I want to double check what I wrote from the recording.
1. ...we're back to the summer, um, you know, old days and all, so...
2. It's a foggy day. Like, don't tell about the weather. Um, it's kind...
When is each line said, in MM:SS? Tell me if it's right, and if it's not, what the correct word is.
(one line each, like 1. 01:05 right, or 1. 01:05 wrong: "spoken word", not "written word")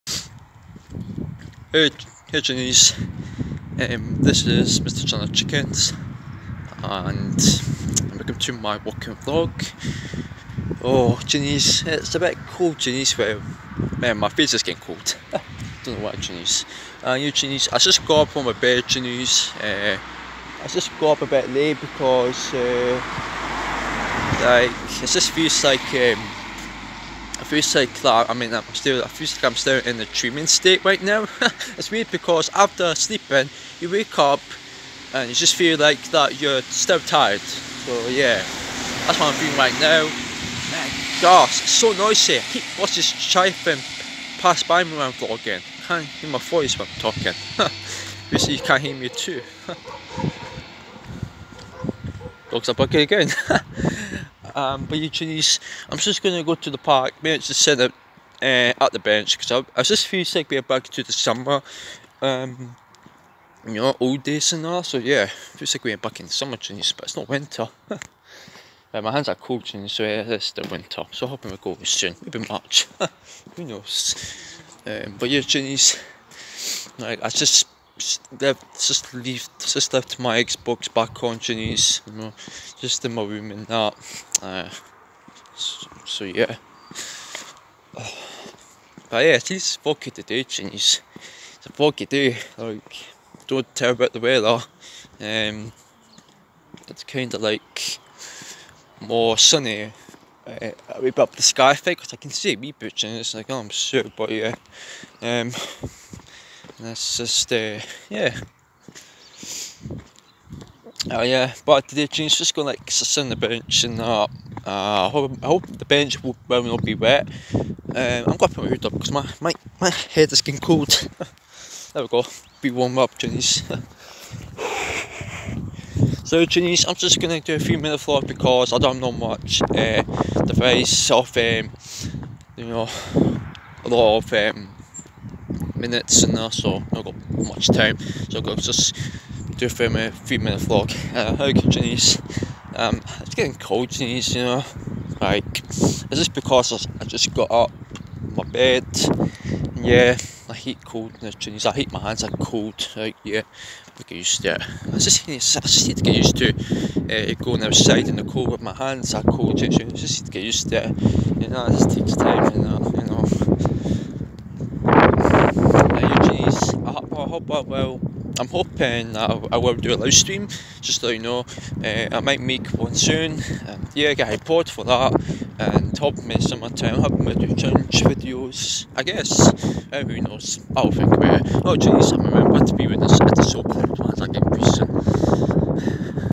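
1. 01:00 right
2. 01:31 right.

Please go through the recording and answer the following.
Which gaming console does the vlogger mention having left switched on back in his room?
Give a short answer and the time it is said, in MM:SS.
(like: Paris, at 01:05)
Xbox, at 01:20.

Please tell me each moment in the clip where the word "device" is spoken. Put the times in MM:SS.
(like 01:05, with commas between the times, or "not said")
02:10.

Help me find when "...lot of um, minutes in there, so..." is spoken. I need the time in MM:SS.
02:13.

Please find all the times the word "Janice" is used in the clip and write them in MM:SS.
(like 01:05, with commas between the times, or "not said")
01:21, 01:30.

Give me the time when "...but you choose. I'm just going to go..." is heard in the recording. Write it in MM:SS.
00:54.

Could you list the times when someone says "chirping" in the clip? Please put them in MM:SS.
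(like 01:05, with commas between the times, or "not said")
00:43.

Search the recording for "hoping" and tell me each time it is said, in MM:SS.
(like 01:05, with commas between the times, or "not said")
01:11, 02:48.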